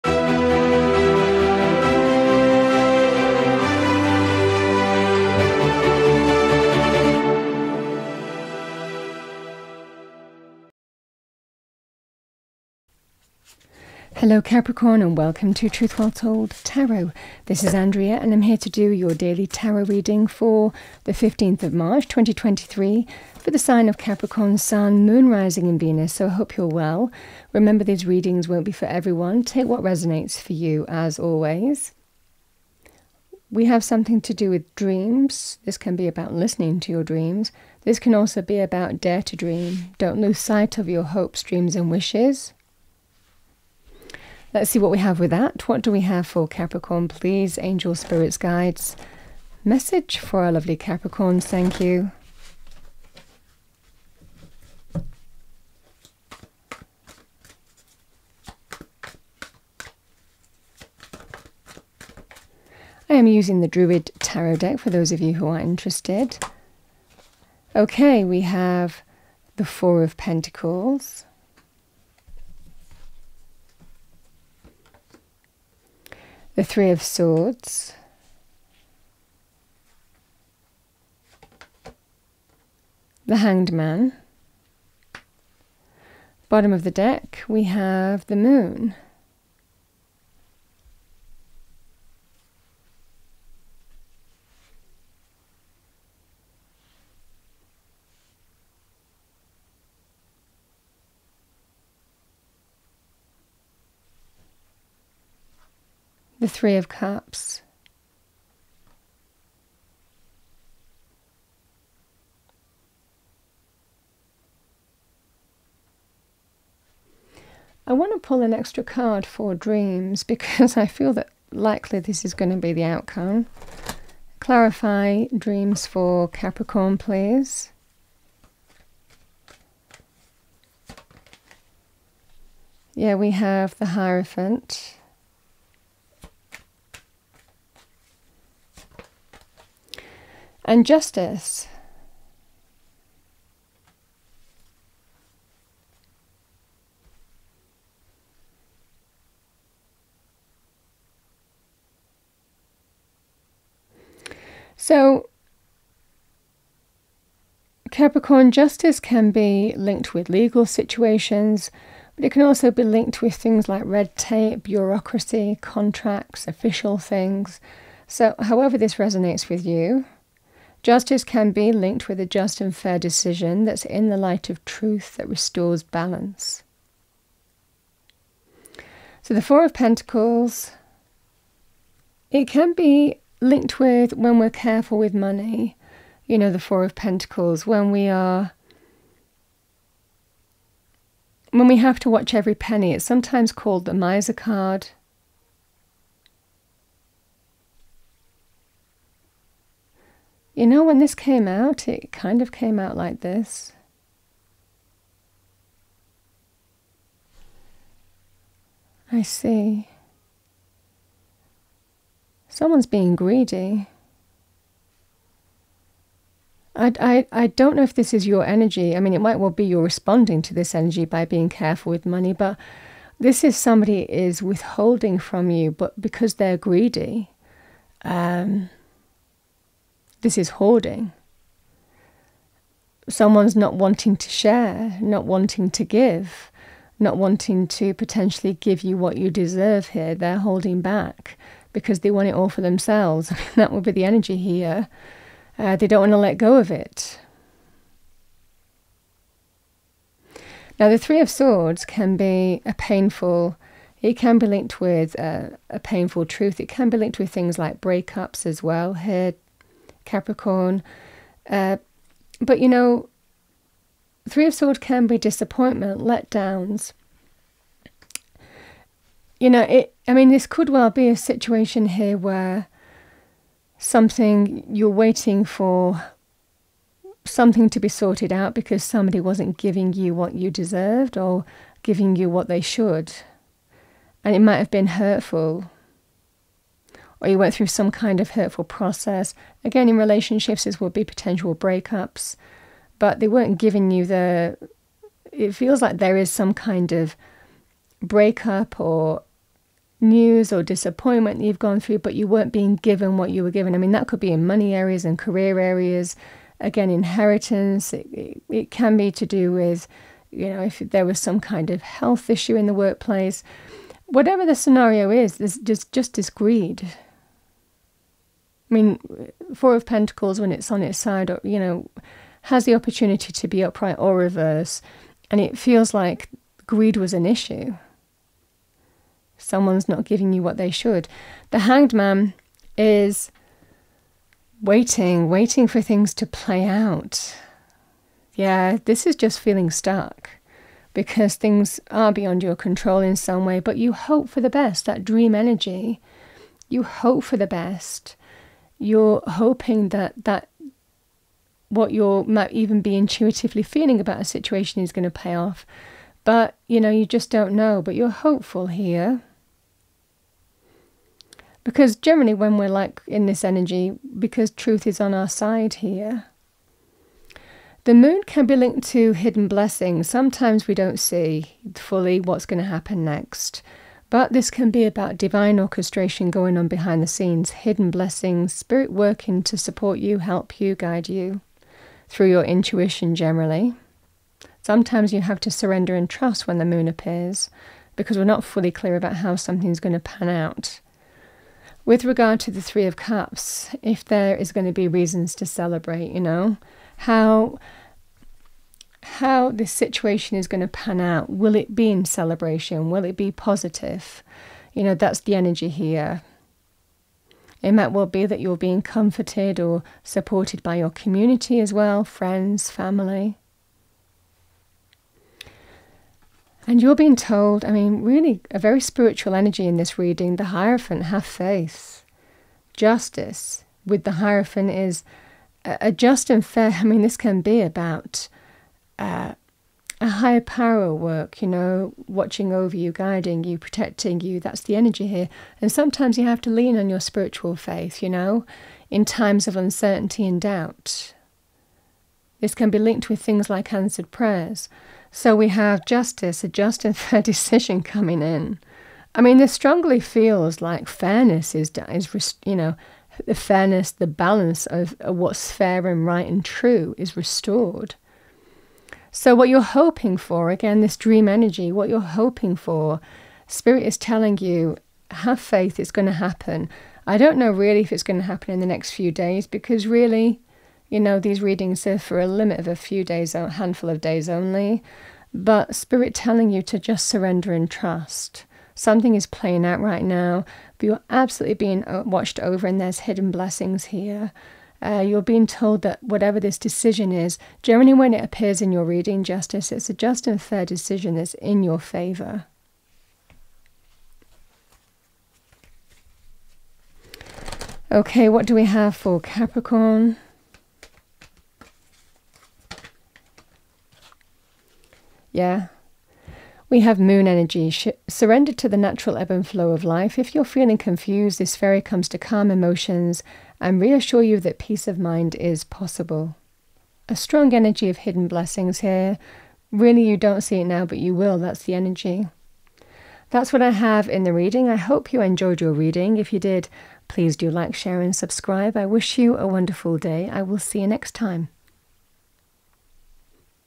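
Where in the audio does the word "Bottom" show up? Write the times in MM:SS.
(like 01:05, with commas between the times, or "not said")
01:26.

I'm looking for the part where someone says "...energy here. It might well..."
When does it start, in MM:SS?
06:45.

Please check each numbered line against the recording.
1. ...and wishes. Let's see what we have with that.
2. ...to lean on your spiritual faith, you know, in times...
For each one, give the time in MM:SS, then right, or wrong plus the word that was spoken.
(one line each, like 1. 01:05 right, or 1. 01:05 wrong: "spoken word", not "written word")
1. 00:41 right
2. 07:16 right.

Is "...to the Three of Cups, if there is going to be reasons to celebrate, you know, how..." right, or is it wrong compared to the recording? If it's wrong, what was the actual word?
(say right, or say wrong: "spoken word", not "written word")
right.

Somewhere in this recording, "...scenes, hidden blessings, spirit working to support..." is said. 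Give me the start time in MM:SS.
06:17.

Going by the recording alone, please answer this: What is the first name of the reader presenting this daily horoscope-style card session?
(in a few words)
Andrea.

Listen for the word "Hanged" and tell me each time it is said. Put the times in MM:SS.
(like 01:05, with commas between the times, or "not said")
01:23, 05:31.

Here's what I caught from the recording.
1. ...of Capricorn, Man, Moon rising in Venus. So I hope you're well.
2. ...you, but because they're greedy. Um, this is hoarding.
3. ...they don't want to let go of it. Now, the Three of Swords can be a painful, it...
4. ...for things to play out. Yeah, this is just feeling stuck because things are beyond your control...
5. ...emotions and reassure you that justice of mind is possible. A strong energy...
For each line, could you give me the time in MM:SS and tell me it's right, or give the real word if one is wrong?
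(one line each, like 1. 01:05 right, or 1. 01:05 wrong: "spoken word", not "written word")
1. 00:23 wrong: "Sun", not "Man"
2. 03:45 right
3. 04:05 right
4. 05:35 right
5. 08:32 wrong: "peace", not "justice".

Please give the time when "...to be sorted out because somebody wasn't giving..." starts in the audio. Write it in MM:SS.
04:37.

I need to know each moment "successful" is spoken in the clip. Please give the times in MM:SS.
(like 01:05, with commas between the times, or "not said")
not said.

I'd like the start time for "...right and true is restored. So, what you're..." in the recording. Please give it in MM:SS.
07:36.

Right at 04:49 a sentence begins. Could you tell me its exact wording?
Again, in relationships, this would be potential breakups, but they weren't giving you the.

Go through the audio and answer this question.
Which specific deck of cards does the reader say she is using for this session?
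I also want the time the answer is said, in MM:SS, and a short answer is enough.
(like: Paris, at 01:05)
Druid Tarot, at 01:03.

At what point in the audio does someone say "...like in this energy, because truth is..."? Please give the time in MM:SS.
06:02.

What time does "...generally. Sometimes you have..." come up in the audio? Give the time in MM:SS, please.
06:23.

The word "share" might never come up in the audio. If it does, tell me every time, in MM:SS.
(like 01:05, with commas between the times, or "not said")
03:54, 08:47.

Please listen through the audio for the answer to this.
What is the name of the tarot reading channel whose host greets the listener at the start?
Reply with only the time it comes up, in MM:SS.
00:15.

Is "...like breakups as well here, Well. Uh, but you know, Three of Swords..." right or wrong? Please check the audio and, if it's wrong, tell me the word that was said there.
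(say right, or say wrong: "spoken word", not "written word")
wrong: "Capricorn", not "Well".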